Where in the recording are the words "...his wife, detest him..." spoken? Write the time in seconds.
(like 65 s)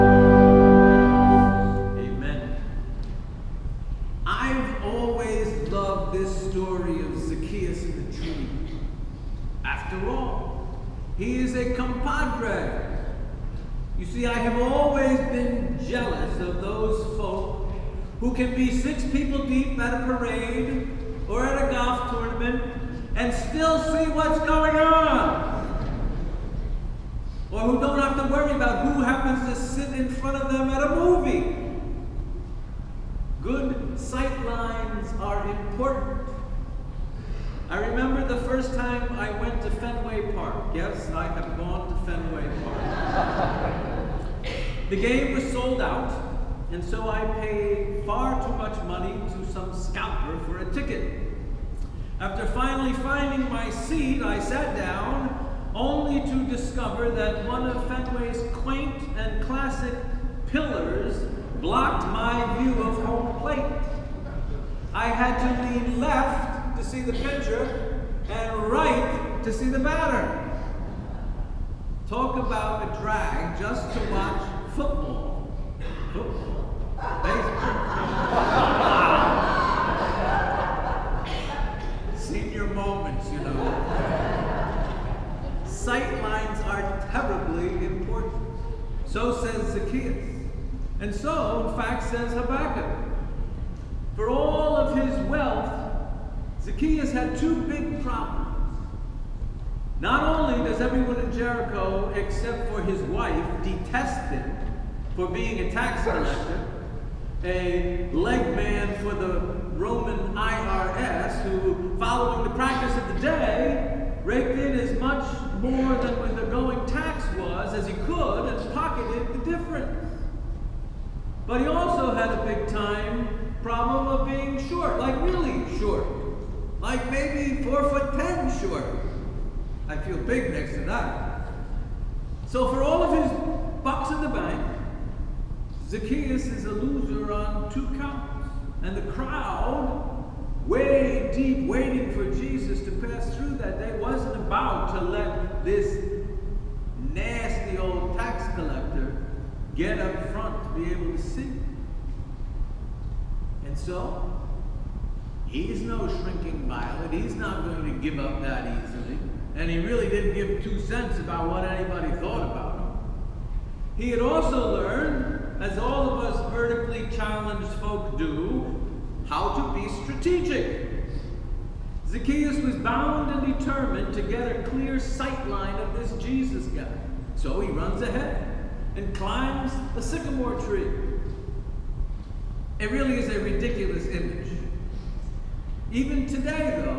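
102 s.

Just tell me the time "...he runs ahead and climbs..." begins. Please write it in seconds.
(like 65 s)
177 s.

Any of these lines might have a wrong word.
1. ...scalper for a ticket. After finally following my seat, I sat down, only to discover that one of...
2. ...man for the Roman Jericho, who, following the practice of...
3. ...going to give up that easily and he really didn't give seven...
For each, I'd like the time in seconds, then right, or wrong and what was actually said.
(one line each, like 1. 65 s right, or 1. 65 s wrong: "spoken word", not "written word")
1. 49 s wrong: "finding", not "following"
2. 108 s wrong: "IRS", not "Jericho"
3. 157 s wrong: "two", not "seven".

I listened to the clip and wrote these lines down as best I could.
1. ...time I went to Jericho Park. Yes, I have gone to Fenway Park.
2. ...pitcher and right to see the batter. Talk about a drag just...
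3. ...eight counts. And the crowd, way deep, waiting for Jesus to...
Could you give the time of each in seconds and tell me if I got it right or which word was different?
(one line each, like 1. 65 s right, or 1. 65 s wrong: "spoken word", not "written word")
1. 38 s wrong: "Fenway", not "Jericho"
2. 67 s right
3. 137 s wrong: "two", not "eight".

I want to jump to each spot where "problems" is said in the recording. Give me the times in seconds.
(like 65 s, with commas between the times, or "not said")
98 s, 123 s.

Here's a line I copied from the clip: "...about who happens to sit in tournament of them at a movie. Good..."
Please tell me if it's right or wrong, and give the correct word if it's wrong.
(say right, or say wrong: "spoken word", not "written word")
wrong: "front", not "tournament".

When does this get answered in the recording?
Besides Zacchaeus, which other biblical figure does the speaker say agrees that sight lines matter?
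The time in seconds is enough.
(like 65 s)
92 s.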